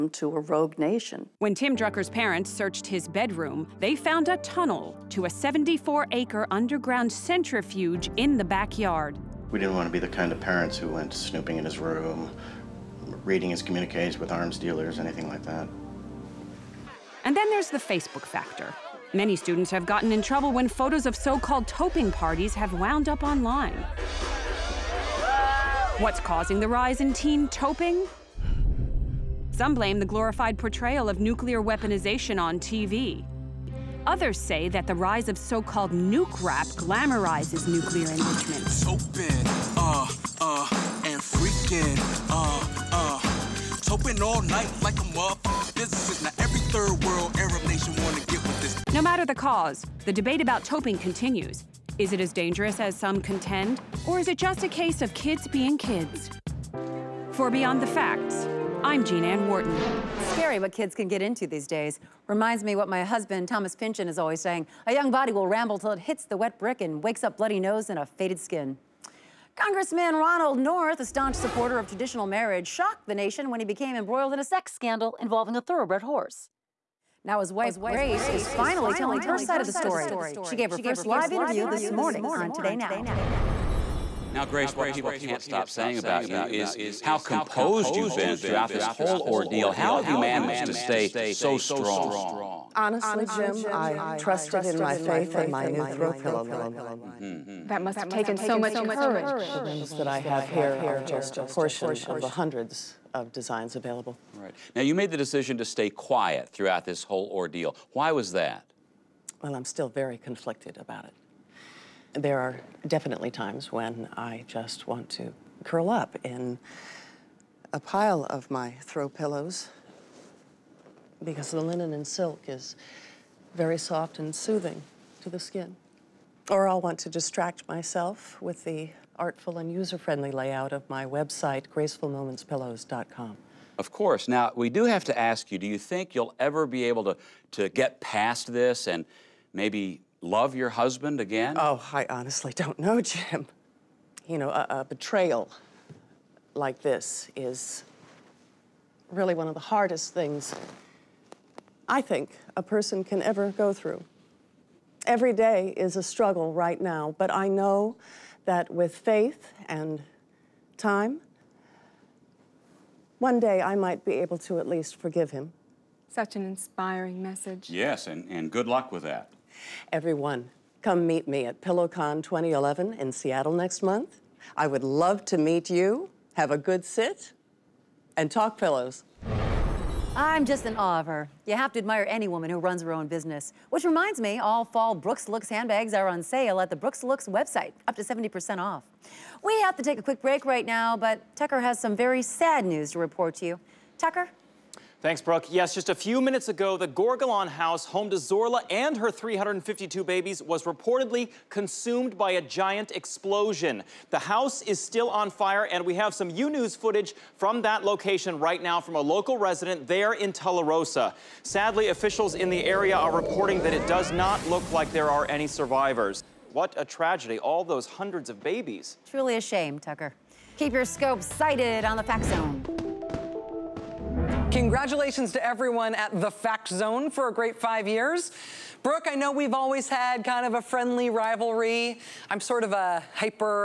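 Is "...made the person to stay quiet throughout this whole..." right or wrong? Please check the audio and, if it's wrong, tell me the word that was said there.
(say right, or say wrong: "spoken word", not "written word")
wrong: "decision", not "person".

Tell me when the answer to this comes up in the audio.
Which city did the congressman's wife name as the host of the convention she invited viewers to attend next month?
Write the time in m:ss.
2:53.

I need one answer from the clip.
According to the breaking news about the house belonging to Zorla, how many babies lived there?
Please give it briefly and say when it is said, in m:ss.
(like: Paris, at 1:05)
352, at 3:19.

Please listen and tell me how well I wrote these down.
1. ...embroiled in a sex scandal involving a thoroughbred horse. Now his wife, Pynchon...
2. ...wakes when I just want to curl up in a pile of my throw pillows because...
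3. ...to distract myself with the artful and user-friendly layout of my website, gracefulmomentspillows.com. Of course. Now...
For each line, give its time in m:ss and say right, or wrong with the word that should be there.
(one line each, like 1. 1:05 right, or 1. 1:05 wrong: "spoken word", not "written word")
1. 1:13 wrong: "Grace", not "Pynchon"
2. 1:53 wrong: "times", not "wakes"
3. 2:07 right.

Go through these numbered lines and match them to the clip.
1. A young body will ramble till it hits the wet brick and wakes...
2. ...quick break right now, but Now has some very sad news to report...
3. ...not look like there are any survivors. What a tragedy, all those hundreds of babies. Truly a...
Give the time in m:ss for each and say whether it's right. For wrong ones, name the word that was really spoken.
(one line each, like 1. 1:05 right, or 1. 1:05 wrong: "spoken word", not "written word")
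1. 1:04 right
2. 3:10 wrong: "Tucker", not "Now"
3. 3:34 right.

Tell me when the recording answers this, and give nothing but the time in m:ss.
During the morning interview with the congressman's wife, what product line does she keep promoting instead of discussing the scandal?
1:35.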